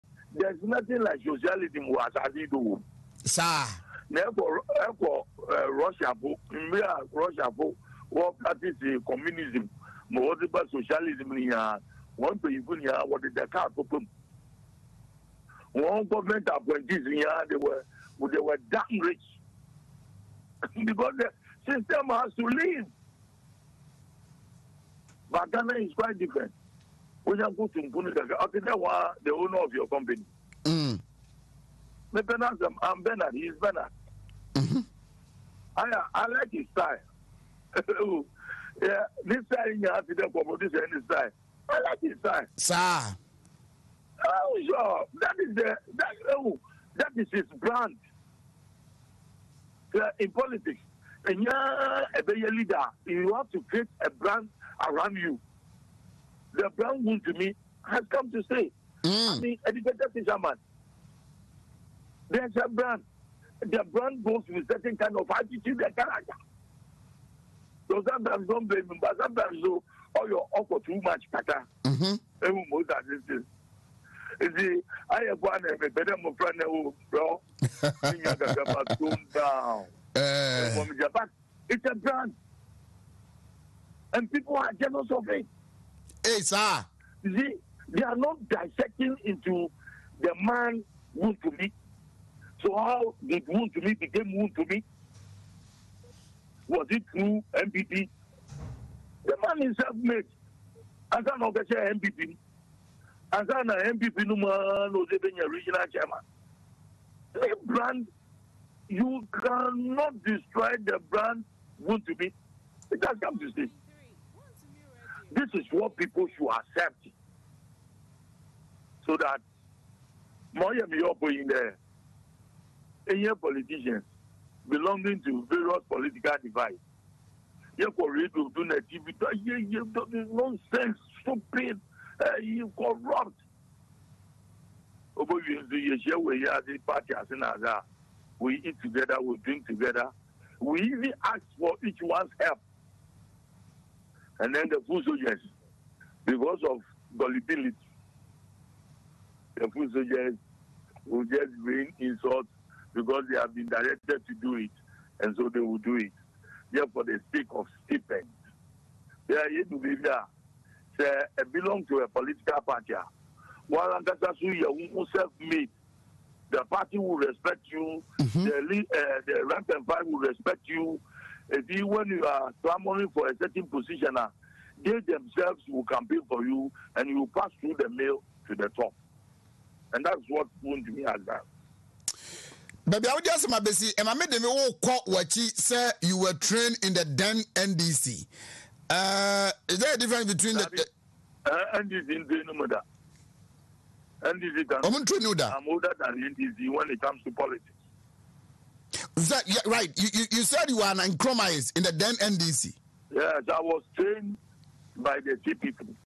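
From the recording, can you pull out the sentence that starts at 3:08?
Uh, is there a difference between that the, uh, NDC And the NDC I'm older than NDC when it comes to politics.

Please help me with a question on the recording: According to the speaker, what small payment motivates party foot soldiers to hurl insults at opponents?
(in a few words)
stipend.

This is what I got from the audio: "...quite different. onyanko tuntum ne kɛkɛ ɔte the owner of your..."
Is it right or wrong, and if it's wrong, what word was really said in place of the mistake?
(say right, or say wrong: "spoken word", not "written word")
right.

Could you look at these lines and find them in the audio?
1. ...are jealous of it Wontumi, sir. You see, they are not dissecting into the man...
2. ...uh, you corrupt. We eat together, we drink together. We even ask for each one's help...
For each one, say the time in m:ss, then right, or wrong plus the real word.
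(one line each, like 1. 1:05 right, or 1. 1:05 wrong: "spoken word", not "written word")
1. 1:24 wrong: "Hey", not "Wontumi"
2. 2:12 right.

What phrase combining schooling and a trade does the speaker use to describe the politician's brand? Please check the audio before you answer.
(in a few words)
educated fisherman.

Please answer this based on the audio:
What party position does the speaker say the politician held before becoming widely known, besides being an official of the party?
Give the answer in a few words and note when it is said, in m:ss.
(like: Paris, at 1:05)
regional chairman, at 1:45.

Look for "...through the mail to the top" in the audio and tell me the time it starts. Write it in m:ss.
2:57.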